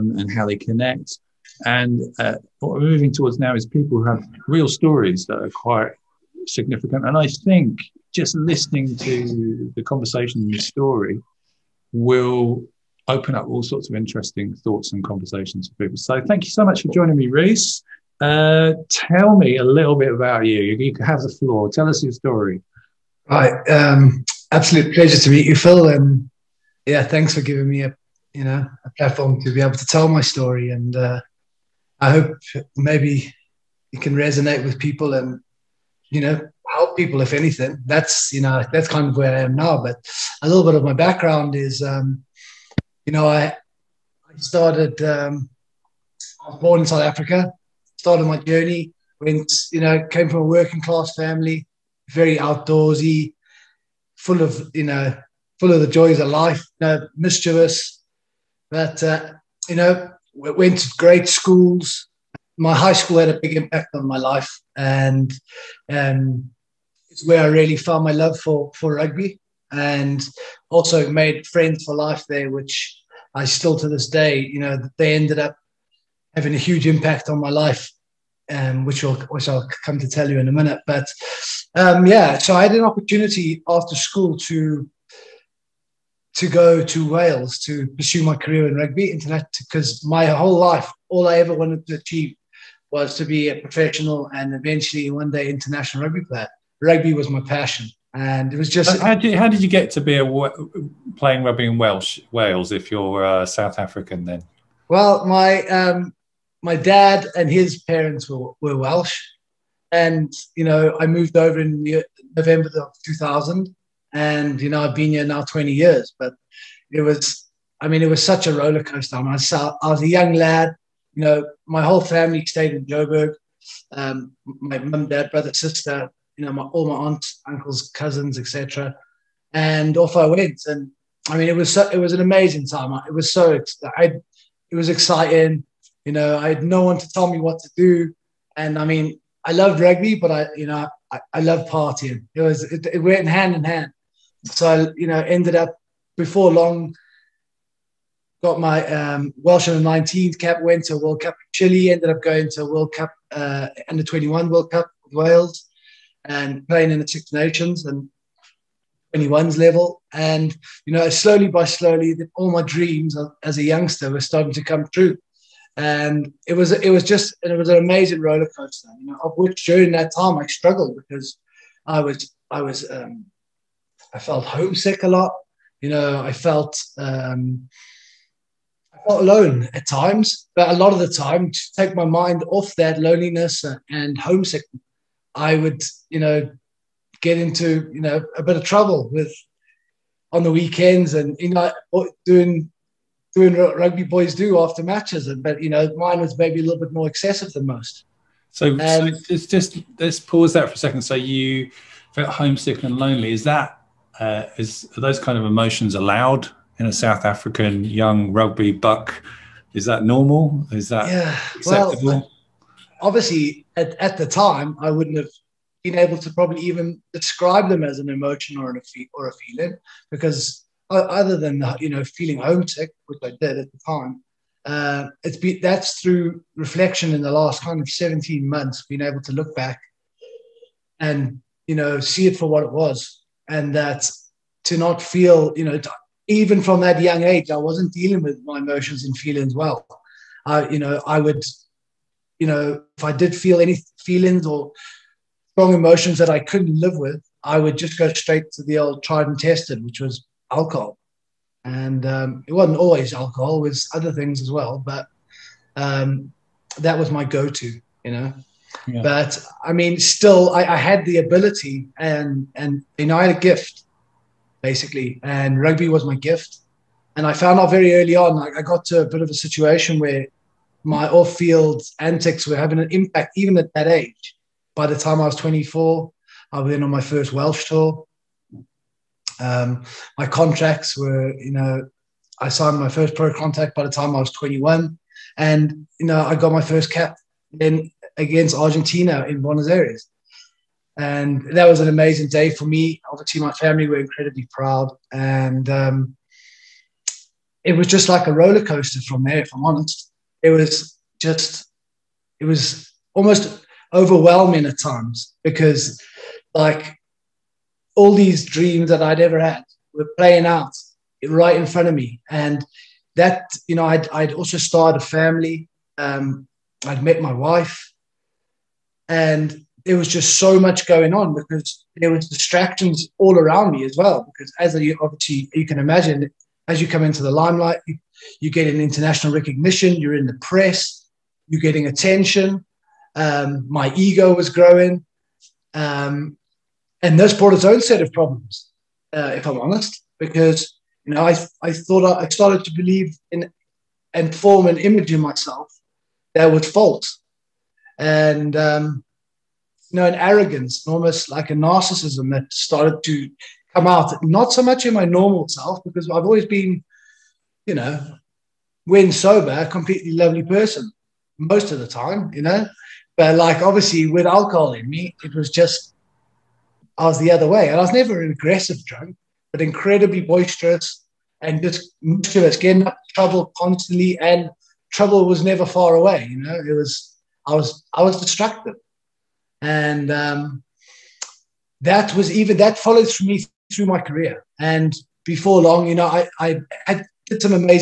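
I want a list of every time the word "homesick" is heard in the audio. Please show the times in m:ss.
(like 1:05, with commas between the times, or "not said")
2:54, 3:04, 3:22, 3:42.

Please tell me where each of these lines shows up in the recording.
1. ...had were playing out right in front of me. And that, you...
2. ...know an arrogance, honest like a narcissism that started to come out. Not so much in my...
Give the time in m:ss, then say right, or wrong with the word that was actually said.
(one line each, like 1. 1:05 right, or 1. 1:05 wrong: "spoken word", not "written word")
1. 5:09 right
2. 5:49 wrong: "almost", not "honest".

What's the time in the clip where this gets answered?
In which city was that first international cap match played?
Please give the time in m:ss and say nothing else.
4:49.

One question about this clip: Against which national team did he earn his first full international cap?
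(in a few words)
Argentina.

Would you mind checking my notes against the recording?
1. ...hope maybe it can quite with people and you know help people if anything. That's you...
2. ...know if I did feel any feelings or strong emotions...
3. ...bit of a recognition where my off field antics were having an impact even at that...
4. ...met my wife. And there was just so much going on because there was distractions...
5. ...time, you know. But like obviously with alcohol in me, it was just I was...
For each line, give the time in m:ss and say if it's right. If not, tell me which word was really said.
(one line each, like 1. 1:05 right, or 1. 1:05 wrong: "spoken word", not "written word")
1. 0:32 wrong: "resonate", not "quite"
2. 4:02 right
3. 4:29 wrong: "situation", not "recognition"
4. 5:17 right
5. 6:01 right.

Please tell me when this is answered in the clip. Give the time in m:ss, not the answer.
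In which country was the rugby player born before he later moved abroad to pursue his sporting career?
0:46.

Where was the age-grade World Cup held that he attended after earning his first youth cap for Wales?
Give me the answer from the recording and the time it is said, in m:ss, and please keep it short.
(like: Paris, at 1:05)
Chile, at 2:31.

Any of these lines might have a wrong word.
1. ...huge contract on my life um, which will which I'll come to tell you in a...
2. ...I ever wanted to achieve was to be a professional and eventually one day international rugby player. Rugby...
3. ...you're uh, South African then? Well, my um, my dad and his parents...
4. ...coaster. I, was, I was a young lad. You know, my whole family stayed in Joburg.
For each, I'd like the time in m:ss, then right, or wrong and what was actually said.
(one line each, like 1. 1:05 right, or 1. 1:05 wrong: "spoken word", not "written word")
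1. 1:16 wrong: "impact", not "contract"
2. 1:31 right
3. 1:42 right
4. 1:58 right.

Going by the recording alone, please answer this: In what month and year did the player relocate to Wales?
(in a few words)
November 2000.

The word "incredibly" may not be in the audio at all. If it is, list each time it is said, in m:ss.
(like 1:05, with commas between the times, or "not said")
4:53, 6:09.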